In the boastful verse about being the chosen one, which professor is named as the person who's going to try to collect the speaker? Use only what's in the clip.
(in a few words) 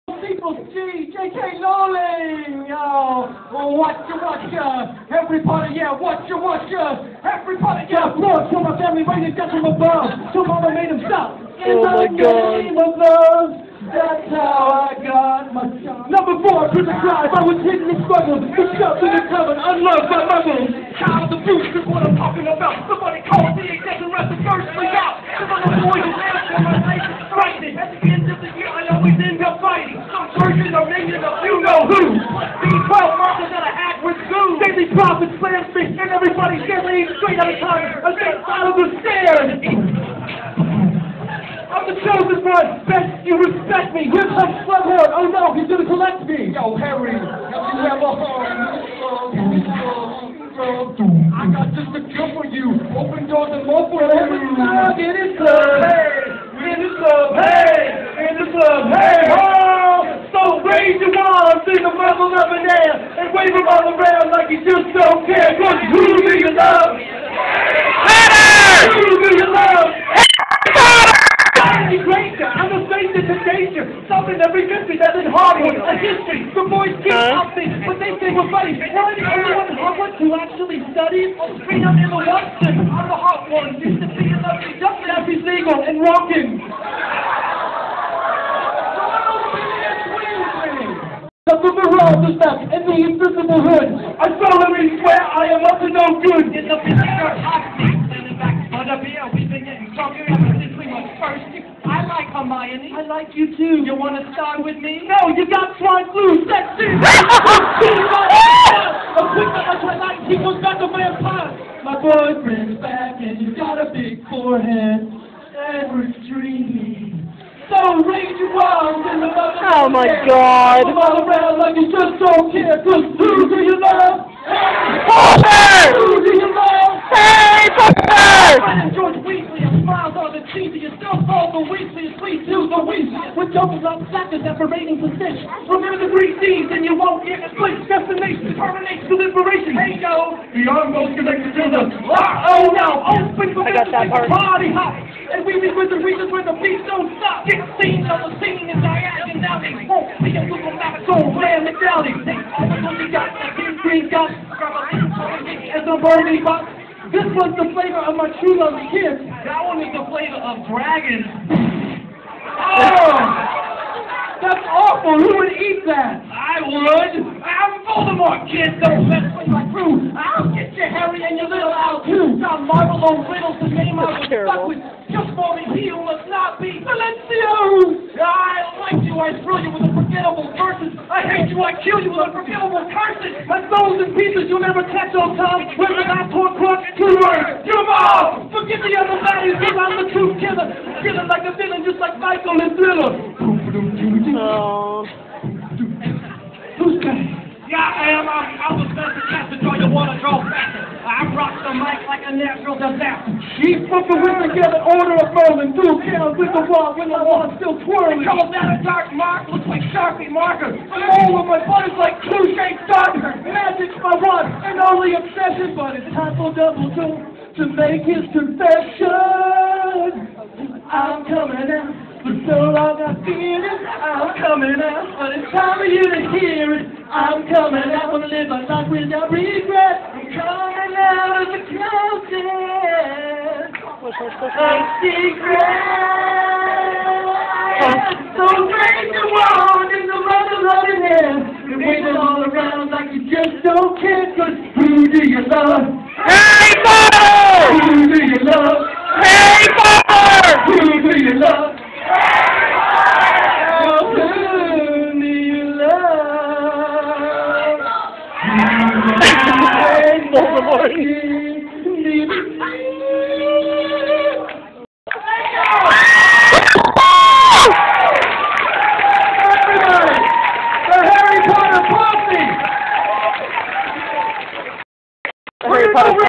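Slughorn.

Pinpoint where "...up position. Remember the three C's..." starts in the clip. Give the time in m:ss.
2:13.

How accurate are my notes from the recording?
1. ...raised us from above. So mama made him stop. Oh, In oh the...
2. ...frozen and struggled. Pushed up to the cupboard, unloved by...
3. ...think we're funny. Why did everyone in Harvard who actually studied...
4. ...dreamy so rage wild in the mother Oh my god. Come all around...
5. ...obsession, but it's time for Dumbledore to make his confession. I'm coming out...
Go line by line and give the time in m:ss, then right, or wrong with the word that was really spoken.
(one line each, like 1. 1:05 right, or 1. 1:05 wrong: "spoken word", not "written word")
1. 0:09 right
2. 0:17 wrong: "hidden", not "frozen"
3. 1:18 right
4. 1:56 right
5. 3:35 right.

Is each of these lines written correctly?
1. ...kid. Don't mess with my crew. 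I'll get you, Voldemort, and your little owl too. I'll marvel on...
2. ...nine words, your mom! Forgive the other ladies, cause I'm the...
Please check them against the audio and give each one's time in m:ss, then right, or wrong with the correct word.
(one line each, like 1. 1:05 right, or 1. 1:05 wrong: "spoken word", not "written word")
1. 2:48 wrong: "Harry", not "Voldemort"
2. 3:07 wrong: "two", not "nine".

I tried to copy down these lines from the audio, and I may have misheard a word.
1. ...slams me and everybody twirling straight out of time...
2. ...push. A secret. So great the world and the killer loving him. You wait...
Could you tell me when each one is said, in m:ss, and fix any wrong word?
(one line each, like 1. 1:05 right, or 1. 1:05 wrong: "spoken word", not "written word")
1. 0:35 wrong: "standing", not "twirling"
2. 3:54 wrong: "mother", not "killer".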